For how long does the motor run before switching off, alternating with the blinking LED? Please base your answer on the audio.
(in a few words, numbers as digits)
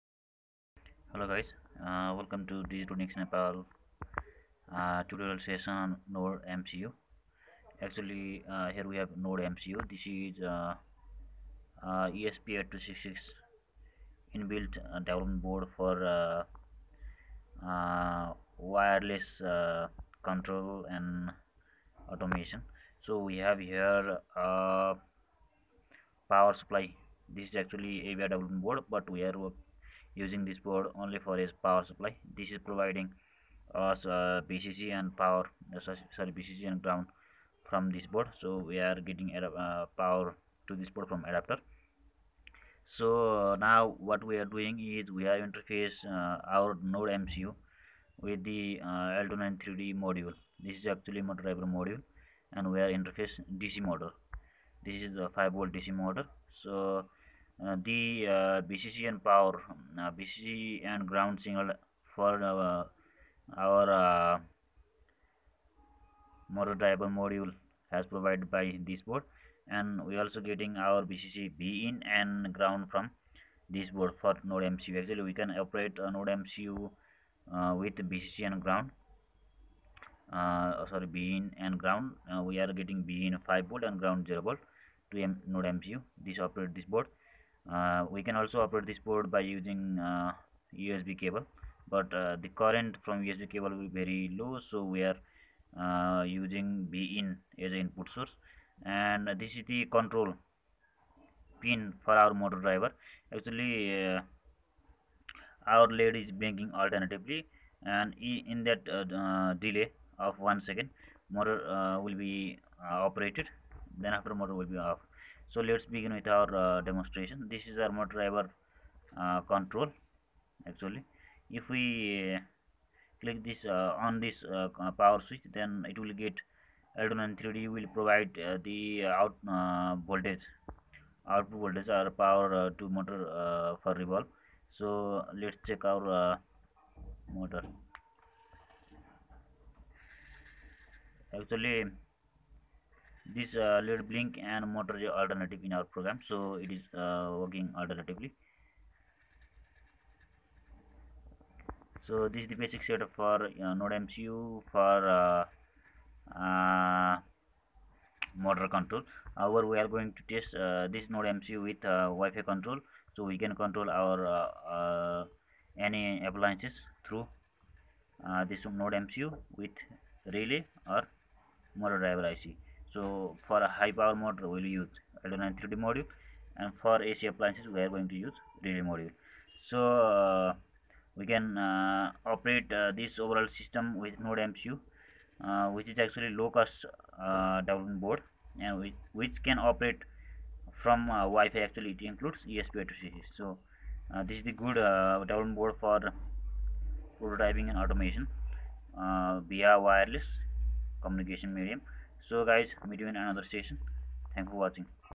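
one second.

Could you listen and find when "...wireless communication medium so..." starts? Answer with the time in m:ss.
3:19.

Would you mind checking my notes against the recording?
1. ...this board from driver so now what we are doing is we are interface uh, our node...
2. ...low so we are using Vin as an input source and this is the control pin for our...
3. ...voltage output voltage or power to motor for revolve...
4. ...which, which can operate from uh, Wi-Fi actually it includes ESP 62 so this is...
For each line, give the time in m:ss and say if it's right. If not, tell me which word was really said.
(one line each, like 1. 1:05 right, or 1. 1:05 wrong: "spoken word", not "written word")
1. 0:40 wrong: "adapter", not "driver"
2. 1:34 right
3. 2:10 right
4. 3:08 wrong: "32", not "62".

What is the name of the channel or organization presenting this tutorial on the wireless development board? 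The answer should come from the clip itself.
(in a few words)
Digitronix Nepal.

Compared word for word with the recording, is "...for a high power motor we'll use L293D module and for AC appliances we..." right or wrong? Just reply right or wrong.
right.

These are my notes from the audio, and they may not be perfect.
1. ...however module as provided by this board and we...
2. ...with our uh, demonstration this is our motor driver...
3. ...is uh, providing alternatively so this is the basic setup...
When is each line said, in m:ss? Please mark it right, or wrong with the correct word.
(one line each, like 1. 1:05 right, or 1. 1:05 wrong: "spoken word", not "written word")
1. 1:06 wrong: "driver", not "however"
2. 1:56 right
3. 2:26 wrong: "working", not "providing".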